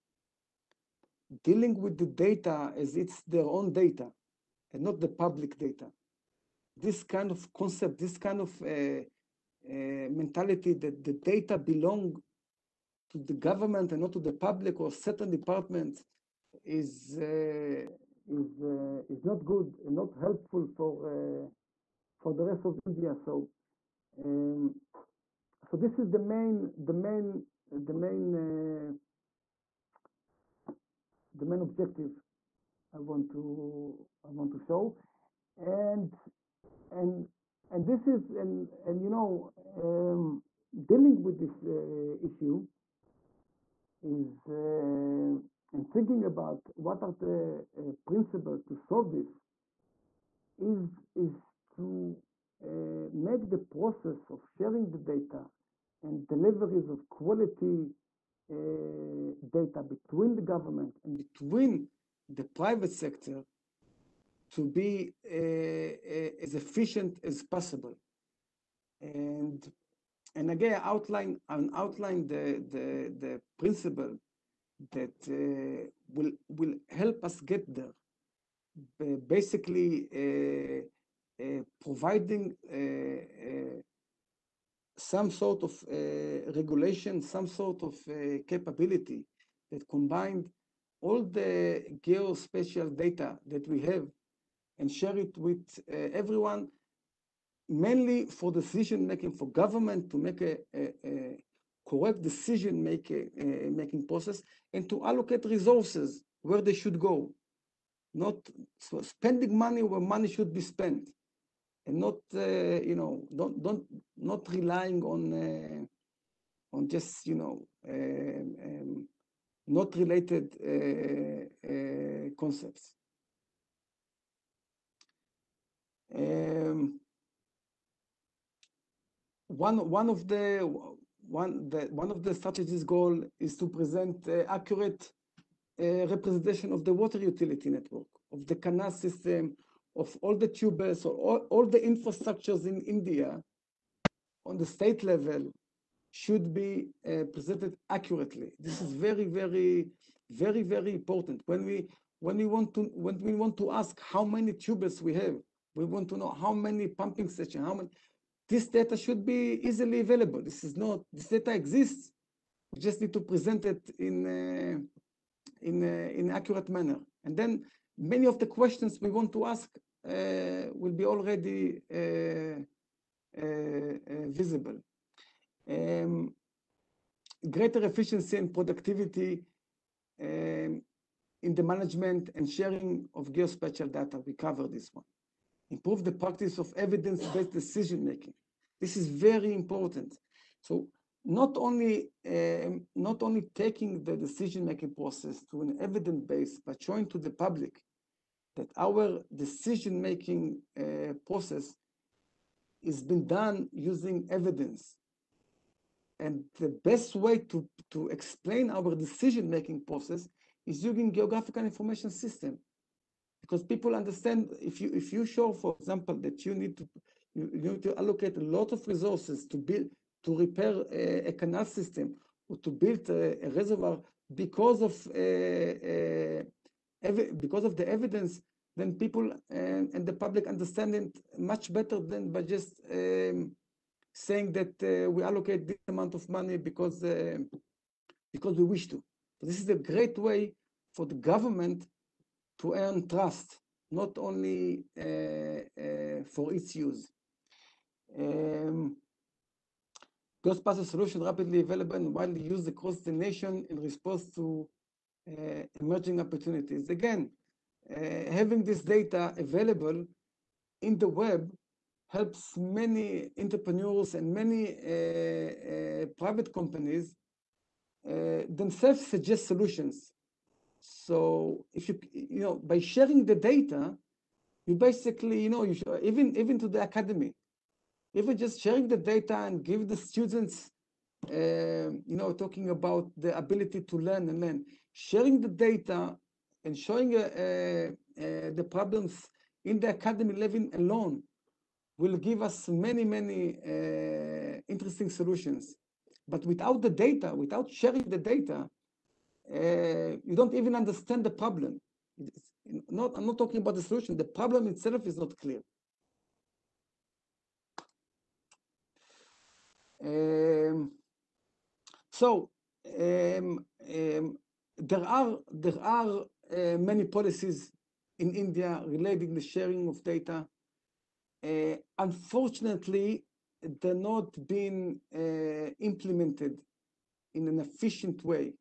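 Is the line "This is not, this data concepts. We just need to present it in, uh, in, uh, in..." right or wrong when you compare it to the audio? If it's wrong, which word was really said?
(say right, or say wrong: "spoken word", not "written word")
wrong: "exists", not "concepts".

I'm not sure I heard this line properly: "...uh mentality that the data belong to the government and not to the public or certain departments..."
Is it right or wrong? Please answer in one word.
right.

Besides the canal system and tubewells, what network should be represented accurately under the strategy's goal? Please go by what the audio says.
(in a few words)
Water utility network.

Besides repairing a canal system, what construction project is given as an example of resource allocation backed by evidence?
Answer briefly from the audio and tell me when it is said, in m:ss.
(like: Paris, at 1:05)
A reservoir, at 3:43.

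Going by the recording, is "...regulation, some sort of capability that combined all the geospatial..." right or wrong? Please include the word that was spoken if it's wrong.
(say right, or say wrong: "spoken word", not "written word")
right.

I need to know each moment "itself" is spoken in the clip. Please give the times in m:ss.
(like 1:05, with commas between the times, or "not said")
5:04.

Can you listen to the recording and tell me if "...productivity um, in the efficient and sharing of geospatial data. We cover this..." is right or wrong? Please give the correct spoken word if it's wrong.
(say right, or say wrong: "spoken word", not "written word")
wrong: "management", not "efficient".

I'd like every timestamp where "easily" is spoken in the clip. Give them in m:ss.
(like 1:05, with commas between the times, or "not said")
2:39.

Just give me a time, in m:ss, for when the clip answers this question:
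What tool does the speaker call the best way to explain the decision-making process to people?
3:31.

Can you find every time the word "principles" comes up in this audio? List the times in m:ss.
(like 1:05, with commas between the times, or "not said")
0:48, 1:13.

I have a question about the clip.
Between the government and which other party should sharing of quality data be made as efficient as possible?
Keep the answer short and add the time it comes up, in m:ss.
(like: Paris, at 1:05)
The private sector, at 1:02.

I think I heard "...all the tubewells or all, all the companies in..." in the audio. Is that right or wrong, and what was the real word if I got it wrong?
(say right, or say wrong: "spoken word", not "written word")
wrong: "infrastructures", not "companies".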